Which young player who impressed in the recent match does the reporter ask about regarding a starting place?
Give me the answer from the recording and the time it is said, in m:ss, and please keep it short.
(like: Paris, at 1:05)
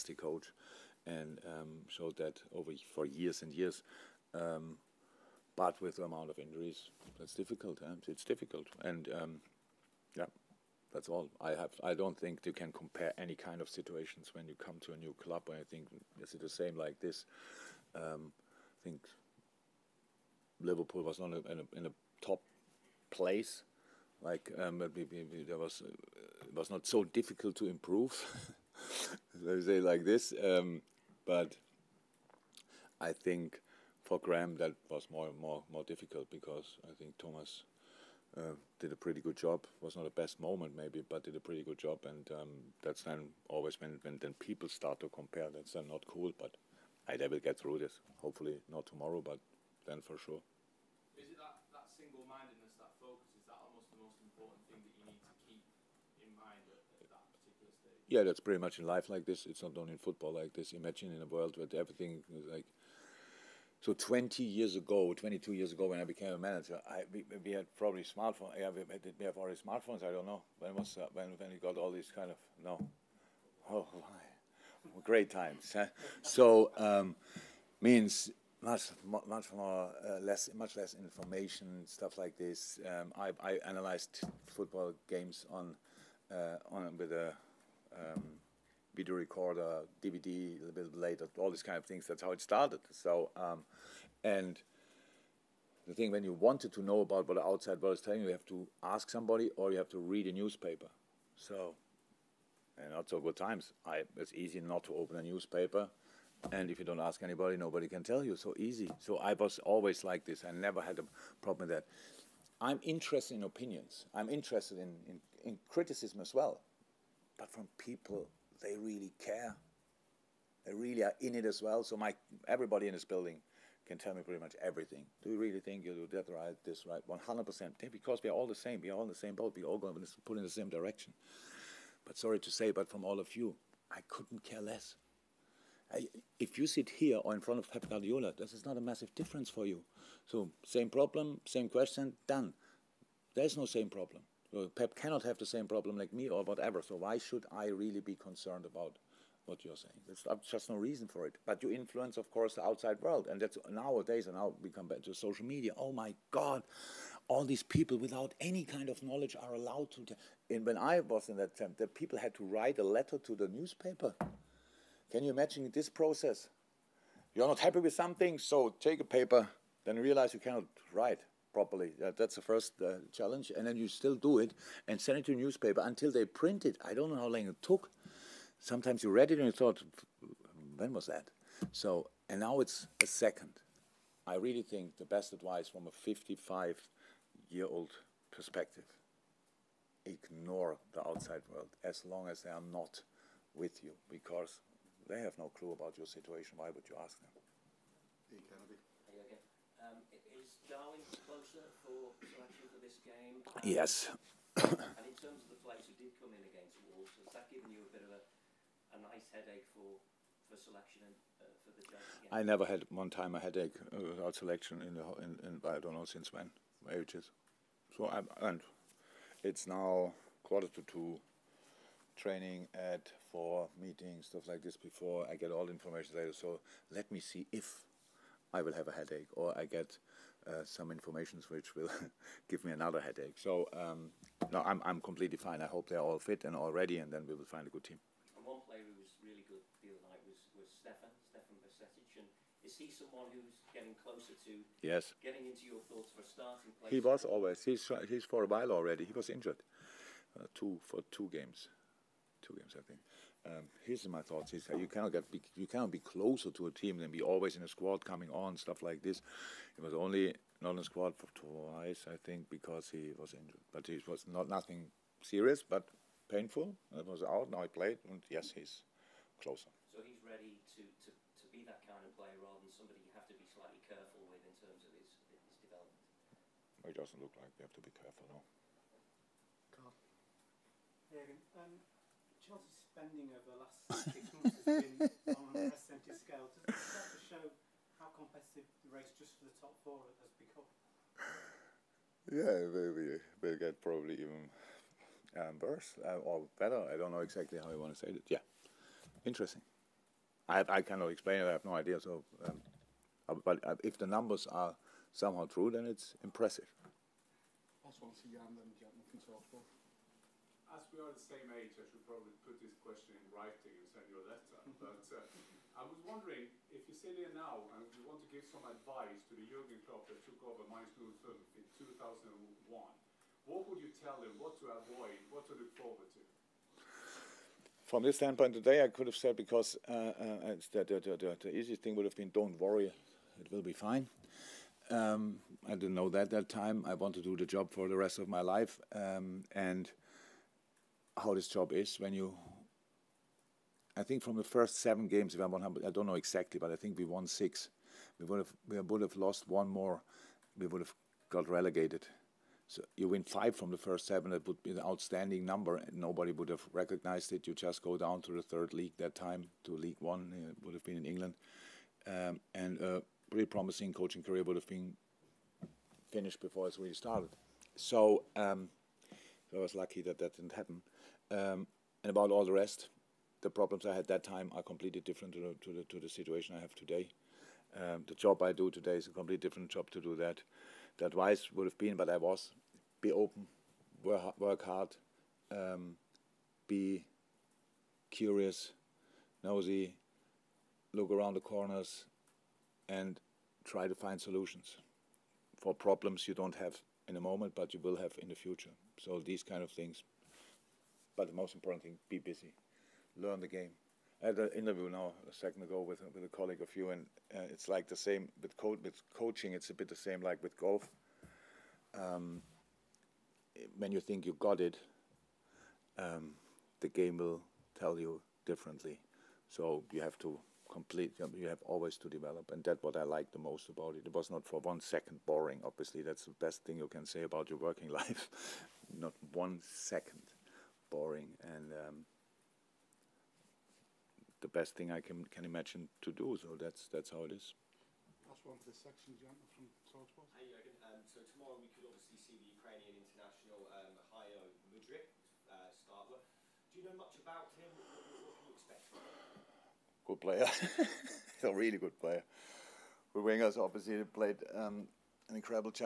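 Stefan Bajcetic, at 4:01.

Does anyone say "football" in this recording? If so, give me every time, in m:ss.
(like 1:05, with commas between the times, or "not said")
1:00, 1:24.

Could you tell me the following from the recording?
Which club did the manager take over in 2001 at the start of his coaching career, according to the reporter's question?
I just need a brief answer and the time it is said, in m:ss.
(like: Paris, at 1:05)
Mainz 05, at 5:20.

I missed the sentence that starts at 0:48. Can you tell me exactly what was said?
Hopefully not tomorrow, but then for sure.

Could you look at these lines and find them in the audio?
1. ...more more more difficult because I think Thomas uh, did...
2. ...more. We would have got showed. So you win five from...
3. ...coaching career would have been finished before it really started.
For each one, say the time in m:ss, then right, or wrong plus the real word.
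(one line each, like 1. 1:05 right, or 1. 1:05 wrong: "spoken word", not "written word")
1. 0:35 right
2. 5:49 wrong: "relegated", not "showed"
3. 6:03 right.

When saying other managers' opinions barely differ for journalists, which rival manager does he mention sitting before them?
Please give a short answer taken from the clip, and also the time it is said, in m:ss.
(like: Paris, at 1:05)
Pep Guardiola, at 2:17.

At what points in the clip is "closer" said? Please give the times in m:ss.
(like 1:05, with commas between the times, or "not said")
4:04, 4:15, 4:29.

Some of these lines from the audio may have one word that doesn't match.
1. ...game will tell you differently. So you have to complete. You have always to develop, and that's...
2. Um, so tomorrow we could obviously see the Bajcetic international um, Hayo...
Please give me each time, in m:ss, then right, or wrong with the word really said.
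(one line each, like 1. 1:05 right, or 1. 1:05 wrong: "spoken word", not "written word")
1. 6:56 right
2. 7:20 wrong: "Ukrainian", not "Bajcetic".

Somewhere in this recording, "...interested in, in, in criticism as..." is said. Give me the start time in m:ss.
1:54.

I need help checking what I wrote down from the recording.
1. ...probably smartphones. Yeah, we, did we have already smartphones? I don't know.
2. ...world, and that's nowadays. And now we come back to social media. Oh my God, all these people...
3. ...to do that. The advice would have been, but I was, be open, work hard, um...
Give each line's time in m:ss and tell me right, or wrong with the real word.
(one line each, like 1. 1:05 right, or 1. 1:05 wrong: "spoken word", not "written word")
1. 1:07 right
2. 2:33 right
3. 6:19 right.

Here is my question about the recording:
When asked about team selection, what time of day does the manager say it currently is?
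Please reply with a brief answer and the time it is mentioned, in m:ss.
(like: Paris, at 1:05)
quarter to two, at 3:40.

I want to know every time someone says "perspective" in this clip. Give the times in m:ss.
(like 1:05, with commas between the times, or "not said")
3:08.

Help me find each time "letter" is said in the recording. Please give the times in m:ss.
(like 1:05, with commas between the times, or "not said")
2:42, 5:14.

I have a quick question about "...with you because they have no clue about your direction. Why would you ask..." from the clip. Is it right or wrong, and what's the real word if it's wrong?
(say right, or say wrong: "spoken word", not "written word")
wrong: "situation", not "direction".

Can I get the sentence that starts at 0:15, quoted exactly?
I think is it the same like this?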